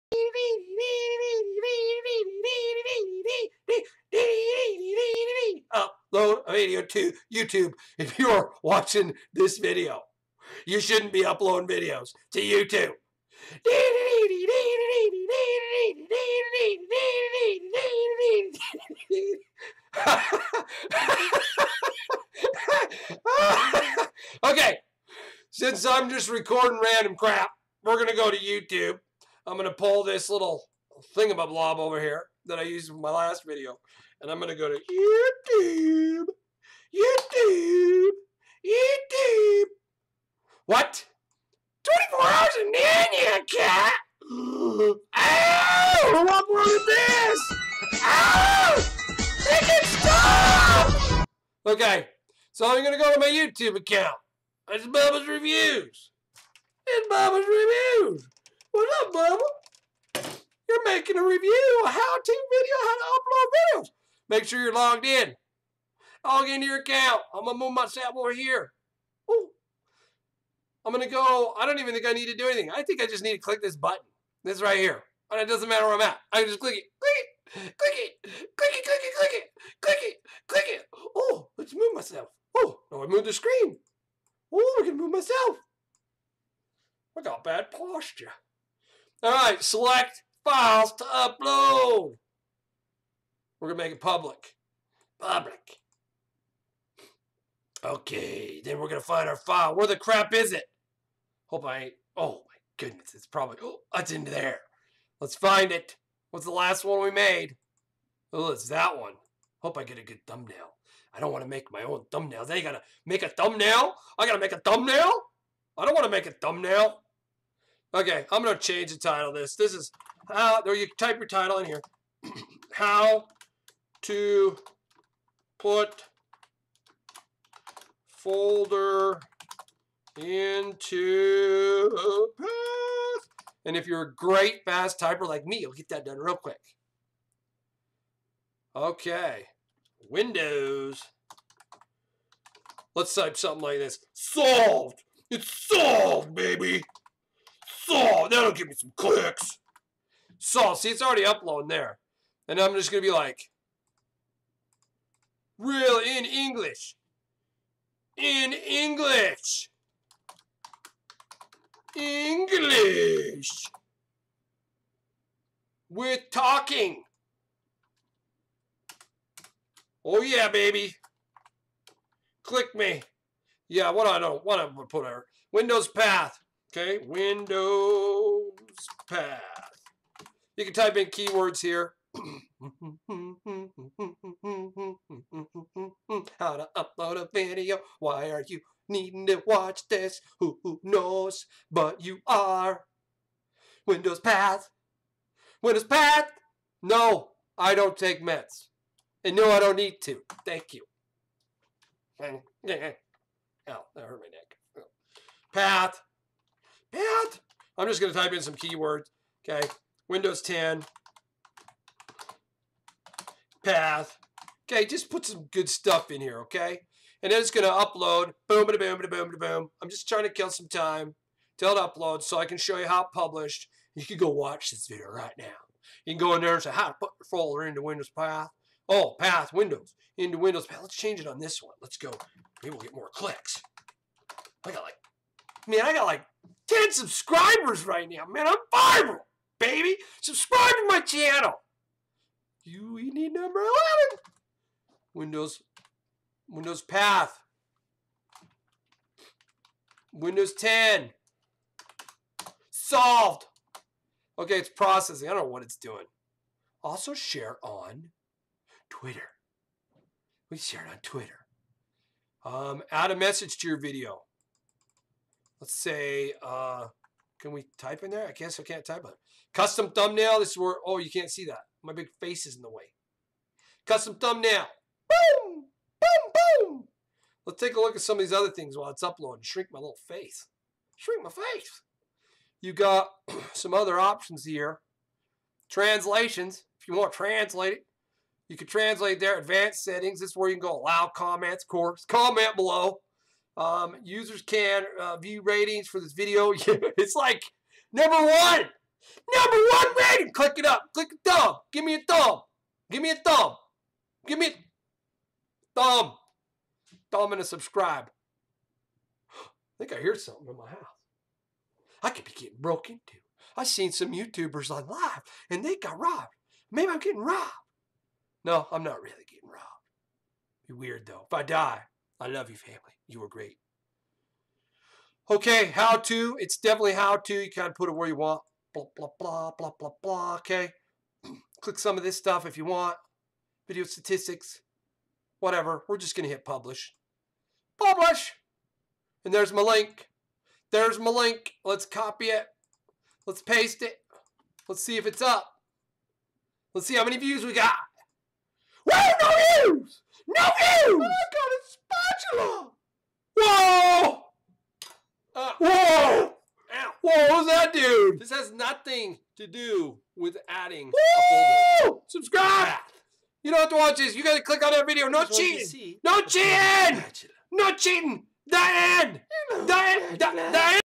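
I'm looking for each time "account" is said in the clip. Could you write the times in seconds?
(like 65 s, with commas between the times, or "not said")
53 s, 66 s.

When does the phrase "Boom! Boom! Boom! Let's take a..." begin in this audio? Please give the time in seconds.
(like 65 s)
275 s.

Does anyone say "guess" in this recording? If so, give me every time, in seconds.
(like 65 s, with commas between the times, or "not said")
268 s.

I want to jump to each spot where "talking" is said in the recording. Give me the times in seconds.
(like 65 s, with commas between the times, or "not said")
166 s.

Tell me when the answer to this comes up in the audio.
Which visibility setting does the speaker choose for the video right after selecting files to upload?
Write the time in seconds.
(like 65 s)
93 s.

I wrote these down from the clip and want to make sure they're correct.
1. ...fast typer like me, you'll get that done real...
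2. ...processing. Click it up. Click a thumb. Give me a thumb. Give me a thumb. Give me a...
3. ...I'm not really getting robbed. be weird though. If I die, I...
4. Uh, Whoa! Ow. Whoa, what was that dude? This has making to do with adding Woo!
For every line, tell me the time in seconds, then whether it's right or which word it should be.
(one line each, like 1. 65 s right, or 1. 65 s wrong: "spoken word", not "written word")
1. 134 s right
2. 300 s wrong: "rating", not "processing"
3. 318 s right
4. 355 s wrong: "nothing", not "making".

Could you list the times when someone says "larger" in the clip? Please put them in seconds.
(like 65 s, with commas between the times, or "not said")
not said.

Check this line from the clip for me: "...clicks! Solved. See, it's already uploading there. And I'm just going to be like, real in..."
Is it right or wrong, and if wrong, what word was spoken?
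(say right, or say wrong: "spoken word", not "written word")
right.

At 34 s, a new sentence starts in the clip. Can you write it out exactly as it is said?
And I'm going to go to YouTube.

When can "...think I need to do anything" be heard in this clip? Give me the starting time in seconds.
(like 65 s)
71 s.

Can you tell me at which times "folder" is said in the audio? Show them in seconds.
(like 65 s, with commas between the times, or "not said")
128 s, 227 s, 361 s.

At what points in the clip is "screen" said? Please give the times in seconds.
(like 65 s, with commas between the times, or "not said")
83 s.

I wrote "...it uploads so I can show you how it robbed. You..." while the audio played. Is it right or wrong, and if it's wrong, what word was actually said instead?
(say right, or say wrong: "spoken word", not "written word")
wrong: "published", not "robbed".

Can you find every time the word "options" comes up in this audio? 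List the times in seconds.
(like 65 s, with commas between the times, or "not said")
283 s.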